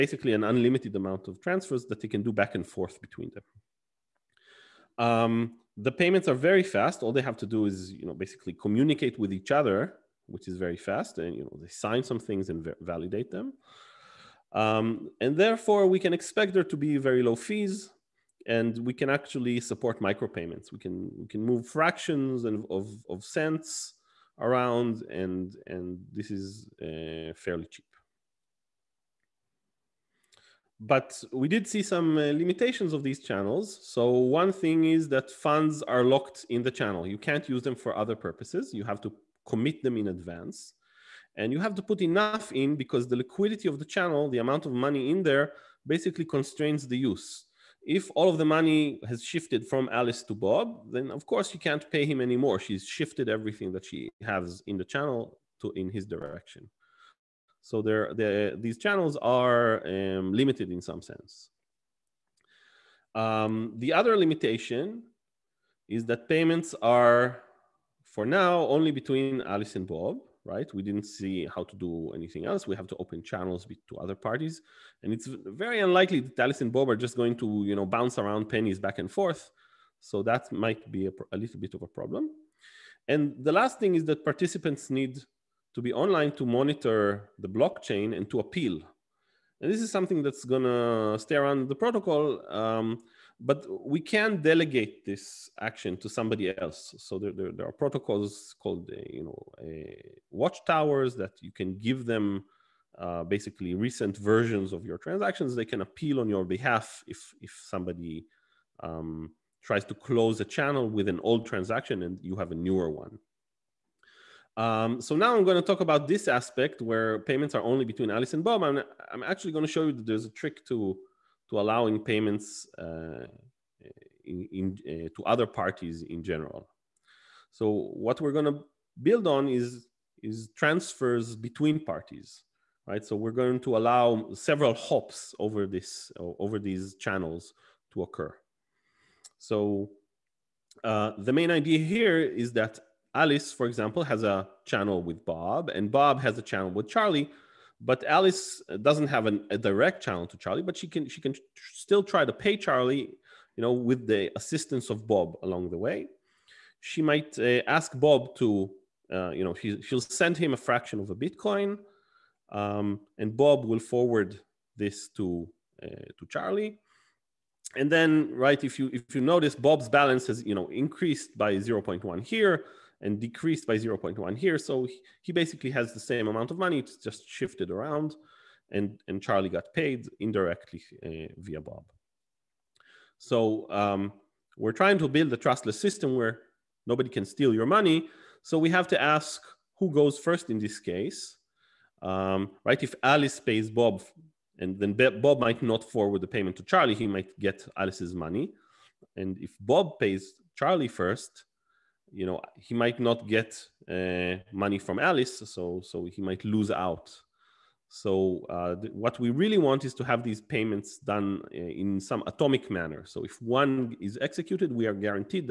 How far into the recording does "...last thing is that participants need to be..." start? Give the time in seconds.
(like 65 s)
83 s.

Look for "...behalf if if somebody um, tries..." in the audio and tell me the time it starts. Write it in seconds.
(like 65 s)
106 s.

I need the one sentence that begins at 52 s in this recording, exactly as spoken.
She's shifted everything that she has in the channel to in his direction.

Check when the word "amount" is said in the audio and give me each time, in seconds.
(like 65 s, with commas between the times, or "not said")
0 s, 44 s, 176 s.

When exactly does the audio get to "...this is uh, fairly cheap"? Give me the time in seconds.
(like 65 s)
26 s.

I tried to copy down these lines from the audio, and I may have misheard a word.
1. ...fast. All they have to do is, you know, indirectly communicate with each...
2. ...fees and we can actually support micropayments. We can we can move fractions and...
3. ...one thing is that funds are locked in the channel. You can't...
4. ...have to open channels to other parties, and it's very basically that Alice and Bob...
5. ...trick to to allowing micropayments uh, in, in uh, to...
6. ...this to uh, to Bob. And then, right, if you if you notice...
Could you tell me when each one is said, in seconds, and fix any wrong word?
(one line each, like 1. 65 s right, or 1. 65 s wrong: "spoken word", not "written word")
1. 6 s wrong: "basically", not "indirectly"
2. 17 s right
3. 34 s right
4. 72 s wrong: "unlikely", not "basically"
5. 120 s wrong: "payments", not "micropayments"
6. 164 s wrong: "Charlie", not "Bob".